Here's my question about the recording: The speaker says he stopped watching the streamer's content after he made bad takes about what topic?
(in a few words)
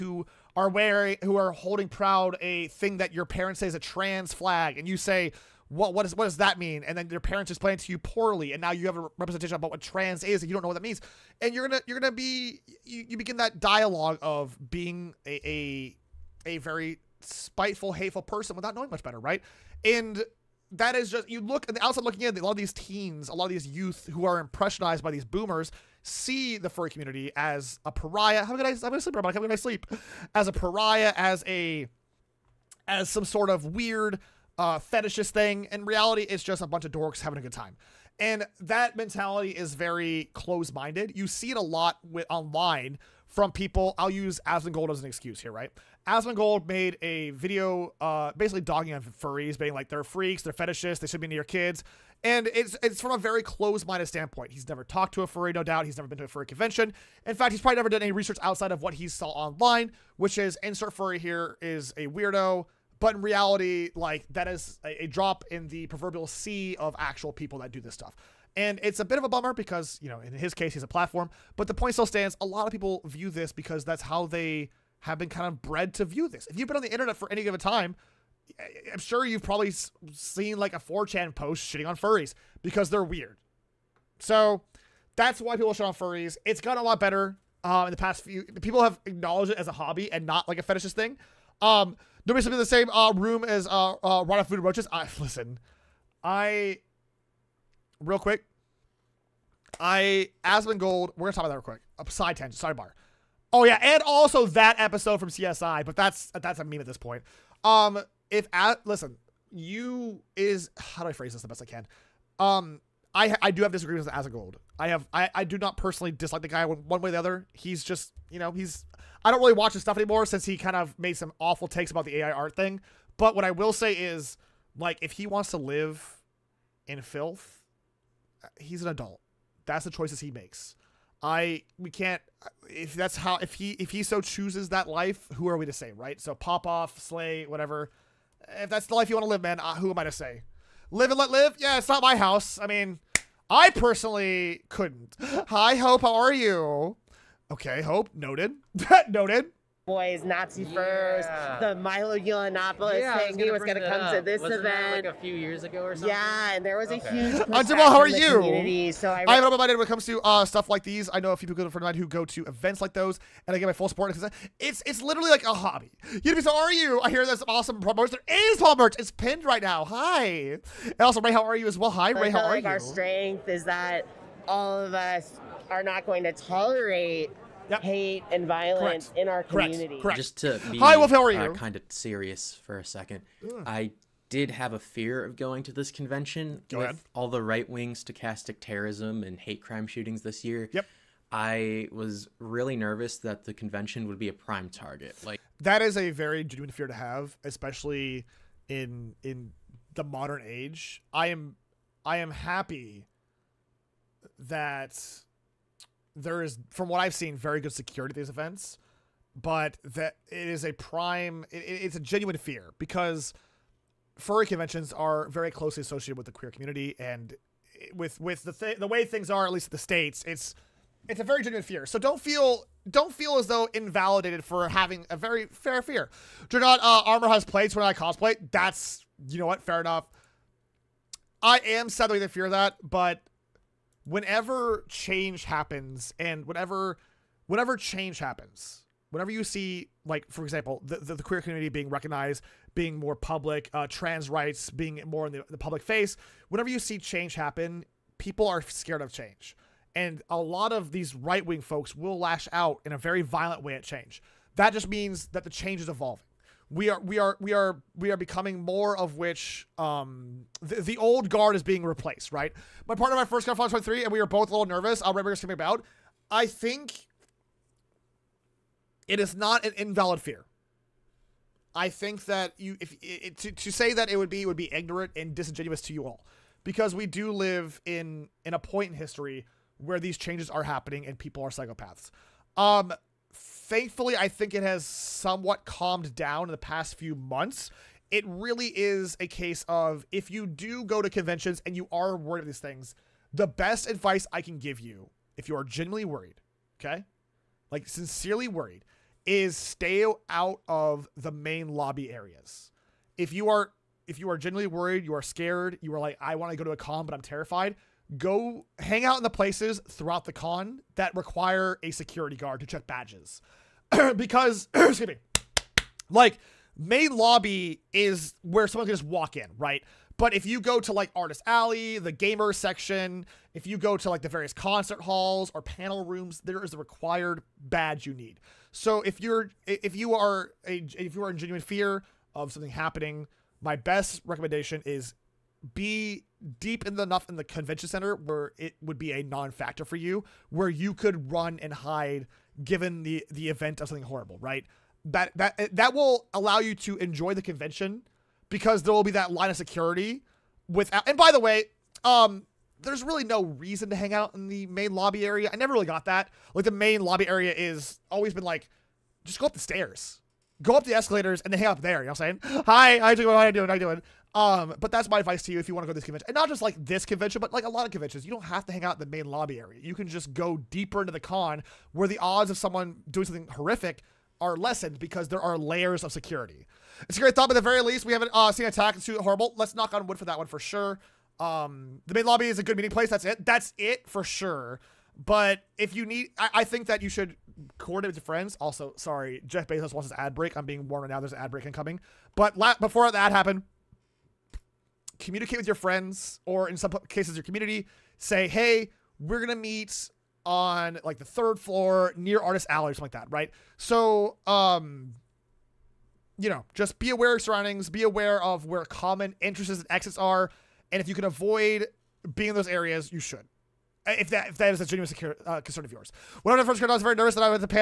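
AI art.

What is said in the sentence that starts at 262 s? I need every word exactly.
My partner and my first got Final 23 and we were both a little nervous.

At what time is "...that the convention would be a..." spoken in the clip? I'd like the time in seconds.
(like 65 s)
193 s.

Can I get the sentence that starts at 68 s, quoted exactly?
And it's a bit of a bummer because, you know, in his case, he's a platform, but the point still stands.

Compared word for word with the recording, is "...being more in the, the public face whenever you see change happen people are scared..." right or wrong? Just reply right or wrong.
right.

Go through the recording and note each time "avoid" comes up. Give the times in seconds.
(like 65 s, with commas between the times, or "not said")
411 s.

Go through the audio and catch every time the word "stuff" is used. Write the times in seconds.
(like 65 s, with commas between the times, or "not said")
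67 s, 119 s, 160 s.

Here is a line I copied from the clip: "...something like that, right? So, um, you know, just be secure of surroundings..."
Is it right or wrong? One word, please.
wrong.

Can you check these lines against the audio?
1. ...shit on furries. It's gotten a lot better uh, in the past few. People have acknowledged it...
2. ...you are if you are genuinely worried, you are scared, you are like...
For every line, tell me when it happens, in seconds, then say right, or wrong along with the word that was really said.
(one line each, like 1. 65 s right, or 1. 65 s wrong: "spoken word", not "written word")
1. 85 s right
2. 303 s right.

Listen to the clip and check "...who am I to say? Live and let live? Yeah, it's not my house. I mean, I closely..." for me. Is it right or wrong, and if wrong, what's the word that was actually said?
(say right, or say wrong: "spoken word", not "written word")
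wrong: "personally", not "closely".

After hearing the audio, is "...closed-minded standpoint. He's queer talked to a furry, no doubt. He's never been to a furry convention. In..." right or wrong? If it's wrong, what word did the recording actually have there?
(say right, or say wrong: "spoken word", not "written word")
wrong: "never", not "queer".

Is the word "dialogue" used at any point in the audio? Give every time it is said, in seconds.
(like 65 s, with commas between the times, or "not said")
13 s.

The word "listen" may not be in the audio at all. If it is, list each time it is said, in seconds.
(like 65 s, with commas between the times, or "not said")
95 s, 108 s.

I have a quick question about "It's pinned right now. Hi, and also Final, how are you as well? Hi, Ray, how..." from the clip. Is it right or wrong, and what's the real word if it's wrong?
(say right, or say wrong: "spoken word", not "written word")
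wrong: "Ray", not "Final".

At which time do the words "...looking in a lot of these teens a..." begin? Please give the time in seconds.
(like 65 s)
22 s.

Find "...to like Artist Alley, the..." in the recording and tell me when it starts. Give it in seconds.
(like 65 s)
320 s.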